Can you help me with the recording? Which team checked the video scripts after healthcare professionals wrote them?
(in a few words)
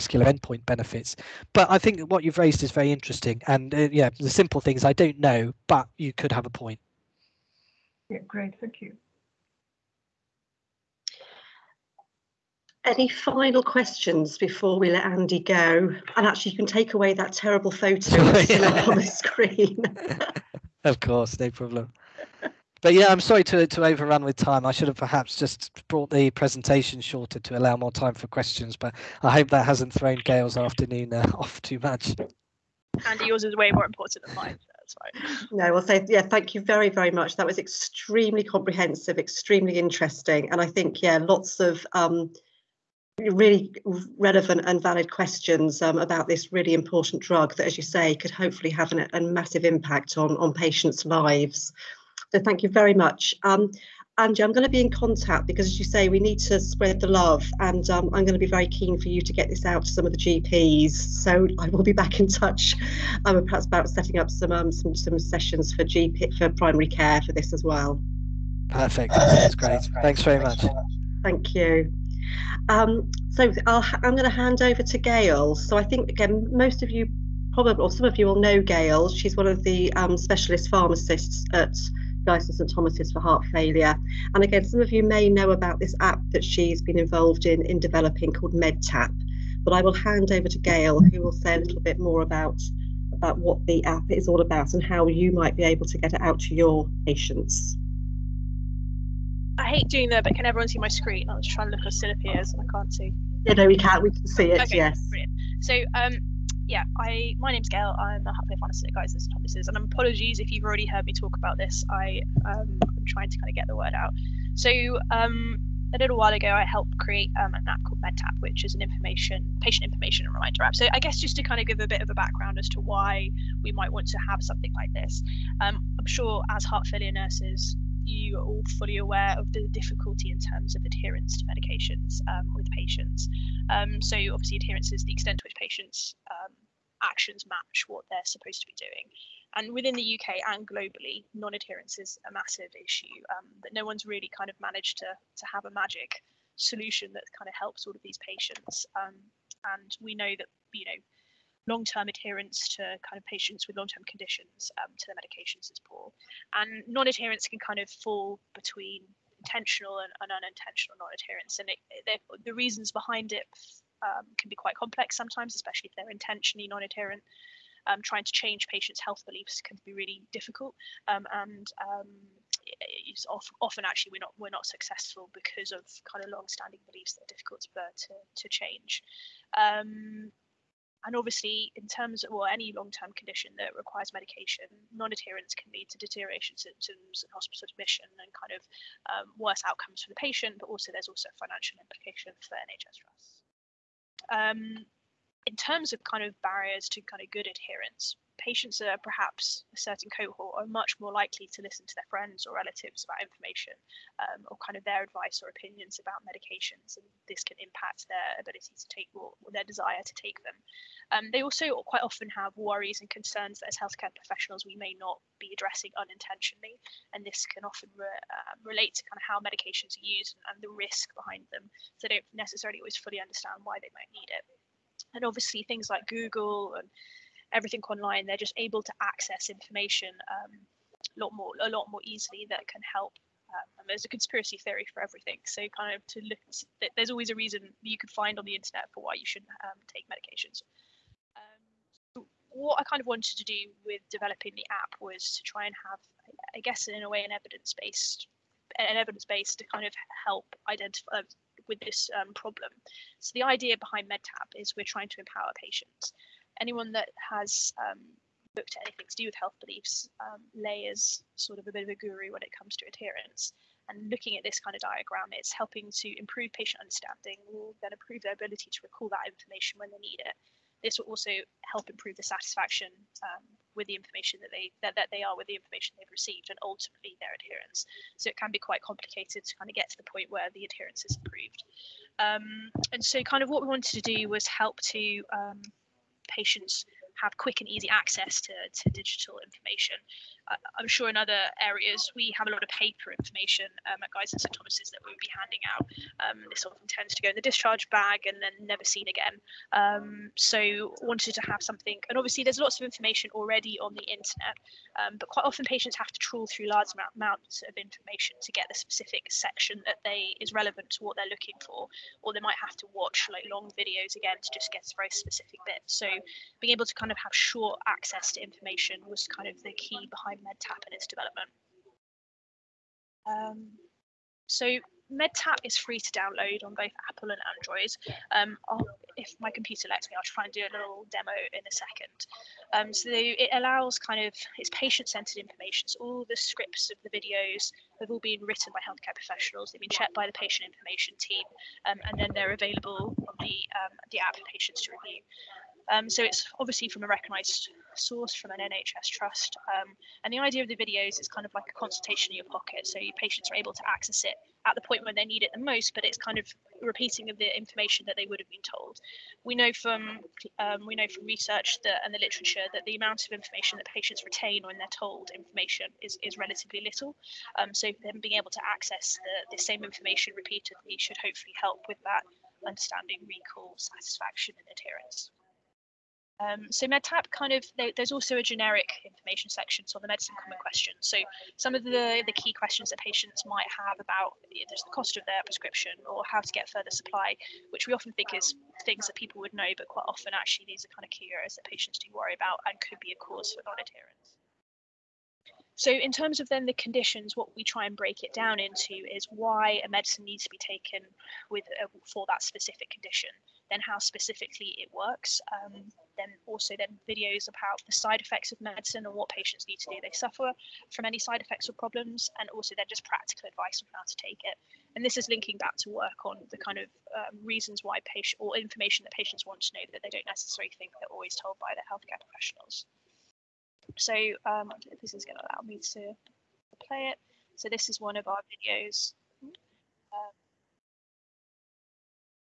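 the patient information team.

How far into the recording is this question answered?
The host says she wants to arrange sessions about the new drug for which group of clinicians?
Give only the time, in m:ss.
1:00.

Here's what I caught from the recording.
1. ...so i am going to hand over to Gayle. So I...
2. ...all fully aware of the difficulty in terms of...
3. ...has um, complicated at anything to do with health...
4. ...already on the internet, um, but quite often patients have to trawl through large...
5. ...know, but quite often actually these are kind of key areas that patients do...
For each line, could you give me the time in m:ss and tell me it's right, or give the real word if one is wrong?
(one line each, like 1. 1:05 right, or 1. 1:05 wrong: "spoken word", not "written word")
1. 1:13 right
2. 2:08 right
3. 4:17 wrong: "looked", not "complicated"
4. 5:03 right
5. 6:29 right.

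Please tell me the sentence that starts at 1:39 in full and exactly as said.
I hate doing that, but can everyone see my screen?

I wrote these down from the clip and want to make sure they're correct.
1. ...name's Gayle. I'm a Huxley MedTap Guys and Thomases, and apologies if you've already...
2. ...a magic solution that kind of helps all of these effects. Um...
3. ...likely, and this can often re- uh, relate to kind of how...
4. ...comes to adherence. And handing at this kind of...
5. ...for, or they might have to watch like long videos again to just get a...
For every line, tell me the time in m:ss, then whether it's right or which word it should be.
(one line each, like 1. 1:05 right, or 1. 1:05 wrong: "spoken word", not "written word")
1. 1:47 wrong: "Fantasy", not "MedTap"
2. 2:25 wrong: "patients", not "effects"
3. 3:35 wrong: "unintentionally", not "likely"
4. 4:22 wrong: "looking", not "handing"
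5. 5:11 right.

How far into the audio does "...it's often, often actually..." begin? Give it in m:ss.
2:53.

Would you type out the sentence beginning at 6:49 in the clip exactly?
They suffer from any side effects or problems, and also then just practical advice on how to take it.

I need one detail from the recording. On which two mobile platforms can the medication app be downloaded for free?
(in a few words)
Apple and Android.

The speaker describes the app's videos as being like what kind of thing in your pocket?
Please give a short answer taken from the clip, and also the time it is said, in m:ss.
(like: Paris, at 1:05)
a consultation, at 5:51.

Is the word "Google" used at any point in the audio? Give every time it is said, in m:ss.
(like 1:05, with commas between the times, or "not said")
3:46.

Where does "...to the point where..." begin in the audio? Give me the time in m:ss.
4:39.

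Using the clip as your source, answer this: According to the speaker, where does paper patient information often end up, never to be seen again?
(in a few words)
the discharge bag.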